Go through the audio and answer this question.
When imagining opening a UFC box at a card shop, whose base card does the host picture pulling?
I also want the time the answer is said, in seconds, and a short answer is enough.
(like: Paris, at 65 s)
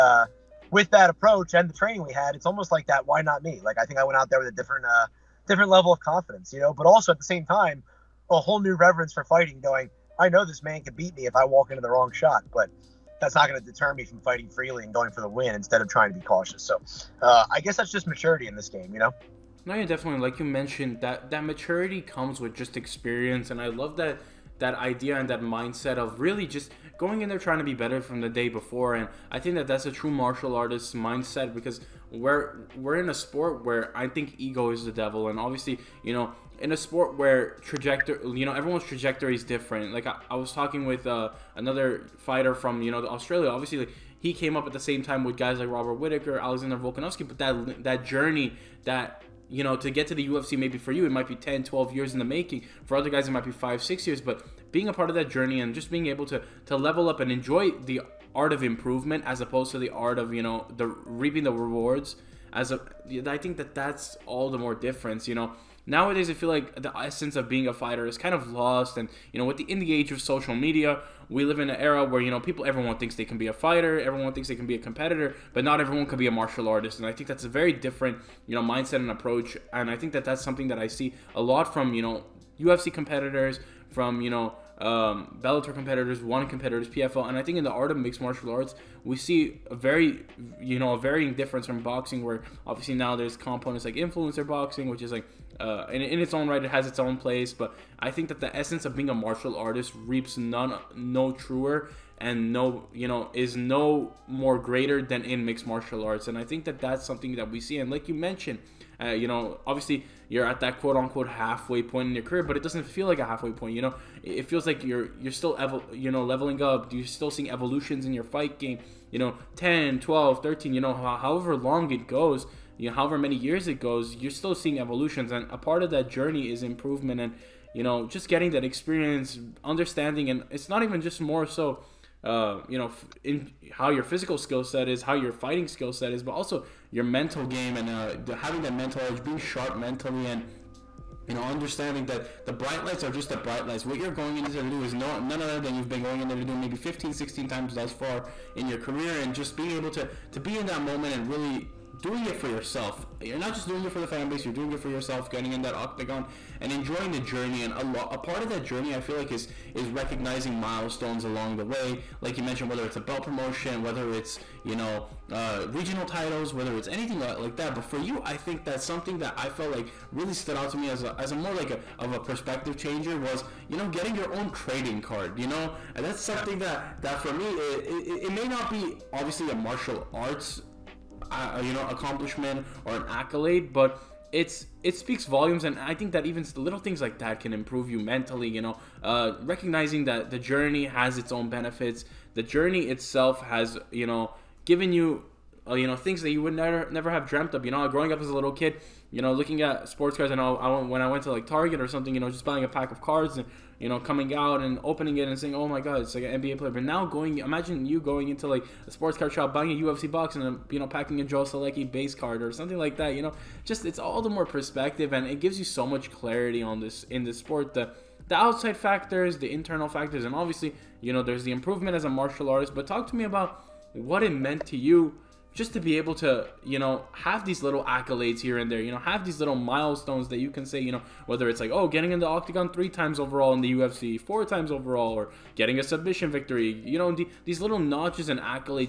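Joe Solecki, at 211 s.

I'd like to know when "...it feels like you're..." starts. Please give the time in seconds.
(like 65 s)
114 s.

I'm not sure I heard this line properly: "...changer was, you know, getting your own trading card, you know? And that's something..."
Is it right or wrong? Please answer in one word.
right.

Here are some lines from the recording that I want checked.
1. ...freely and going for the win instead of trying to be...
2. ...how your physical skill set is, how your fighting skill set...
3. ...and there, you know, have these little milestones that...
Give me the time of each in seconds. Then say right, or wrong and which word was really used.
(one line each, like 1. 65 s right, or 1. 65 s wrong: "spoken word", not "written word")
1. 14 s right
2. 133 s right
3. 228 s right.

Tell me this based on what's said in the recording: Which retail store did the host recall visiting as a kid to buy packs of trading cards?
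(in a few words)
Target.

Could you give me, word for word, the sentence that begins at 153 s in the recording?
You're not just doing it for the fan base, you're doing it for yourself, getting in that octagon and enjoying the journey.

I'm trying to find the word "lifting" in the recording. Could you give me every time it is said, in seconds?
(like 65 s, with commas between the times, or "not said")
not said.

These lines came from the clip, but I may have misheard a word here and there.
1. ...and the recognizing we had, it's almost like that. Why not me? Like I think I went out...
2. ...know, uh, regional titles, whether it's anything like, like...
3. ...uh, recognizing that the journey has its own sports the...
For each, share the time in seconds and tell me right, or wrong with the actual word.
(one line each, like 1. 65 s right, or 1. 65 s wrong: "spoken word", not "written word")
1. 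1 s wrong: "training", not "recognizing"
2. 164 s right
3. 189 s wrong: "benefits", not "sports".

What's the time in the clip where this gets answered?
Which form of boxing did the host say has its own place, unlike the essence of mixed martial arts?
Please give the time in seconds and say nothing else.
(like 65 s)
93 s.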